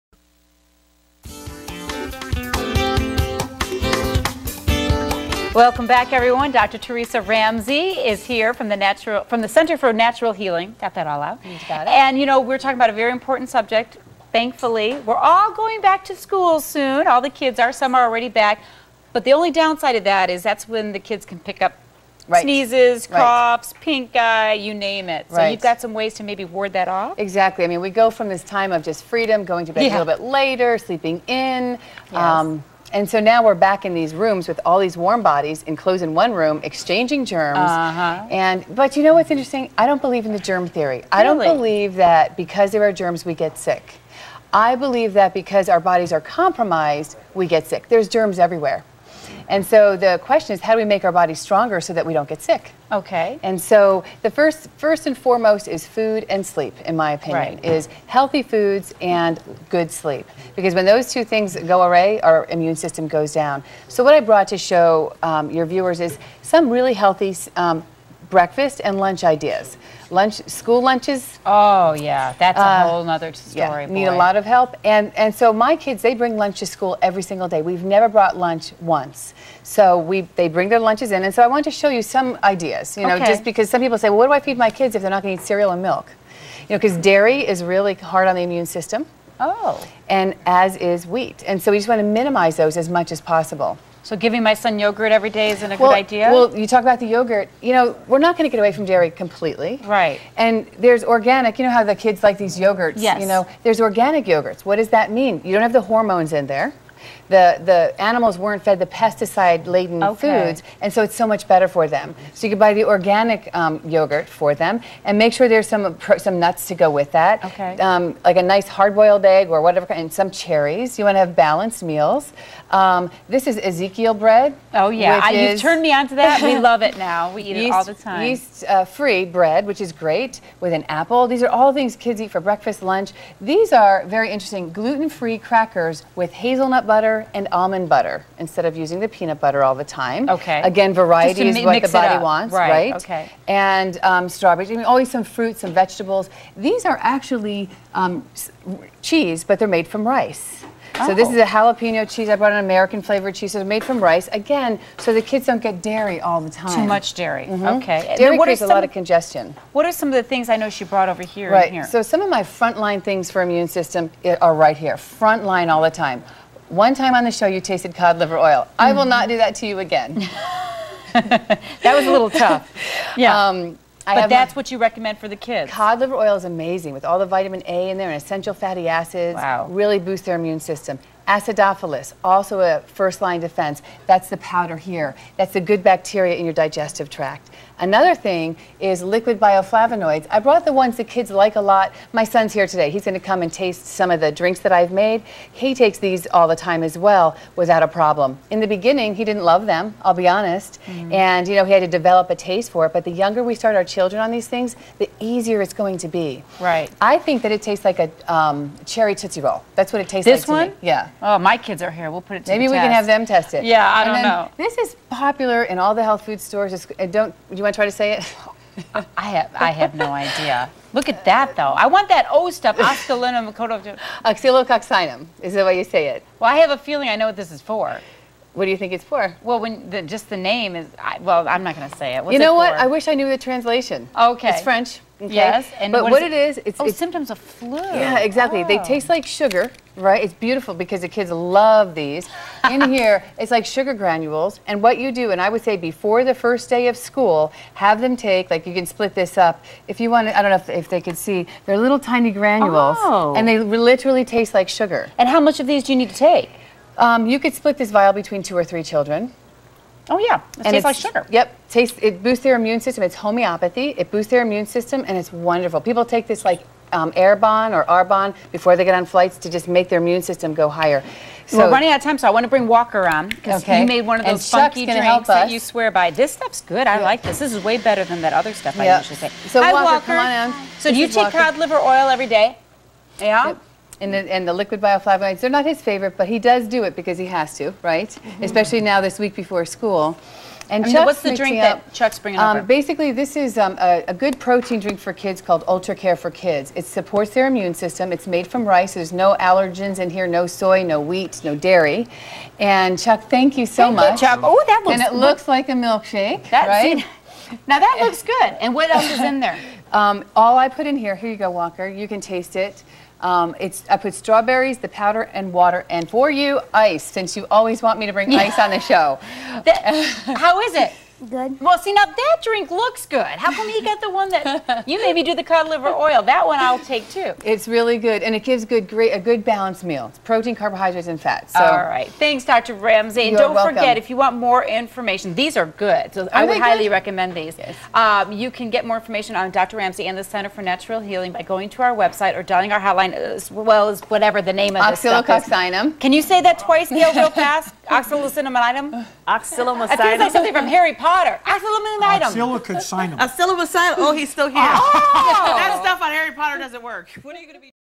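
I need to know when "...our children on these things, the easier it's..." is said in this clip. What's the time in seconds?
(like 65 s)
203 s.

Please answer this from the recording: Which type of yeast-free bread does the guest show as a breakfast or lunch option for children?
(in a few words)
Ezekiel bread.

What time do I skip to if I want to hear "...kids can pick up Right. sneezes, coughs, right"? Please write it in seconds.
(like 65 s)
20 s.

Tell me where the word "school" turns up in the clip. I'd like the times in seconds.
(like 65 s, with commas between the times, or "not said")
16 s, 70 s, 76 s, 246 s, 289 s.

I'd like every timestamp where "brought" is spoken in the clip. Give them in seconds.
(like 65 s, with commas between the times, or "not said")
64 s, 78 s, 152 s, 160 s, 190 s.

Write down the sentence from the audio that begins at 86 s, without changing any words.
You know, because dairy is really hard on the immune system.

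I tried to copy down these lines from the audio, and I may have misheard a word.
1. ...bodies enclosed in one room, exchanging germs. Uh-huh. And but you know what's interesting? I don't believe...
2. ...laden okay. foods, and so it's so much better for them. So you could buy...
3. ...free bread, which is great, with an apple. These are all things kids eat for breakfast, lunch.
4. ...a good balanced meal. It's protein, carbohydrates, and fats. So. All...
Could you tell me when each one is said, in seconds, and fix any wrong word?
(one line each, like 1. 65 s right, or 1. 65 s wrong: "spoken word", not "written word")
1. 35 s right
2. 109 s right
3. 128 s right
4. 329 s right.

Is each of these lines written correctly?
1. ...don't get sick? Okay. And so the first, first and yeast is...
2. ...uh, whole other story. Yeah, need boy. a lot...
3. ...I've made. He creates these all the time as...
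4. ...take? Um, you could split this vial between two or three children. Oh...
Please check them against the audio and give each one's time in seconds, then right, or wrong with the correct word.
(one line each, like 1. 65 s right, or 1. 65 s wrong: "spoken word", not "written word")
1. 52 s wrong: "foremost", not "yeast"
2. 72 s right
3. 194 s wrong: "takes", not "creates"
4. 256 s right.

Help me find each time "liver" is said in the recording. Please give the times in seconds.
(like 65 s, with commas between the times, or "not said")
168 s, 175 s, 281 s, 325 s.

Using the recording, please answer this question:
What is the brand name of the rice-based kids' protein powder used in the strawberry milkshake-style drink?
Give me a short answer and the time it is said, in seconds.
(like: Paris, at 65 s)
Ultra Care for Kids, at 295 s.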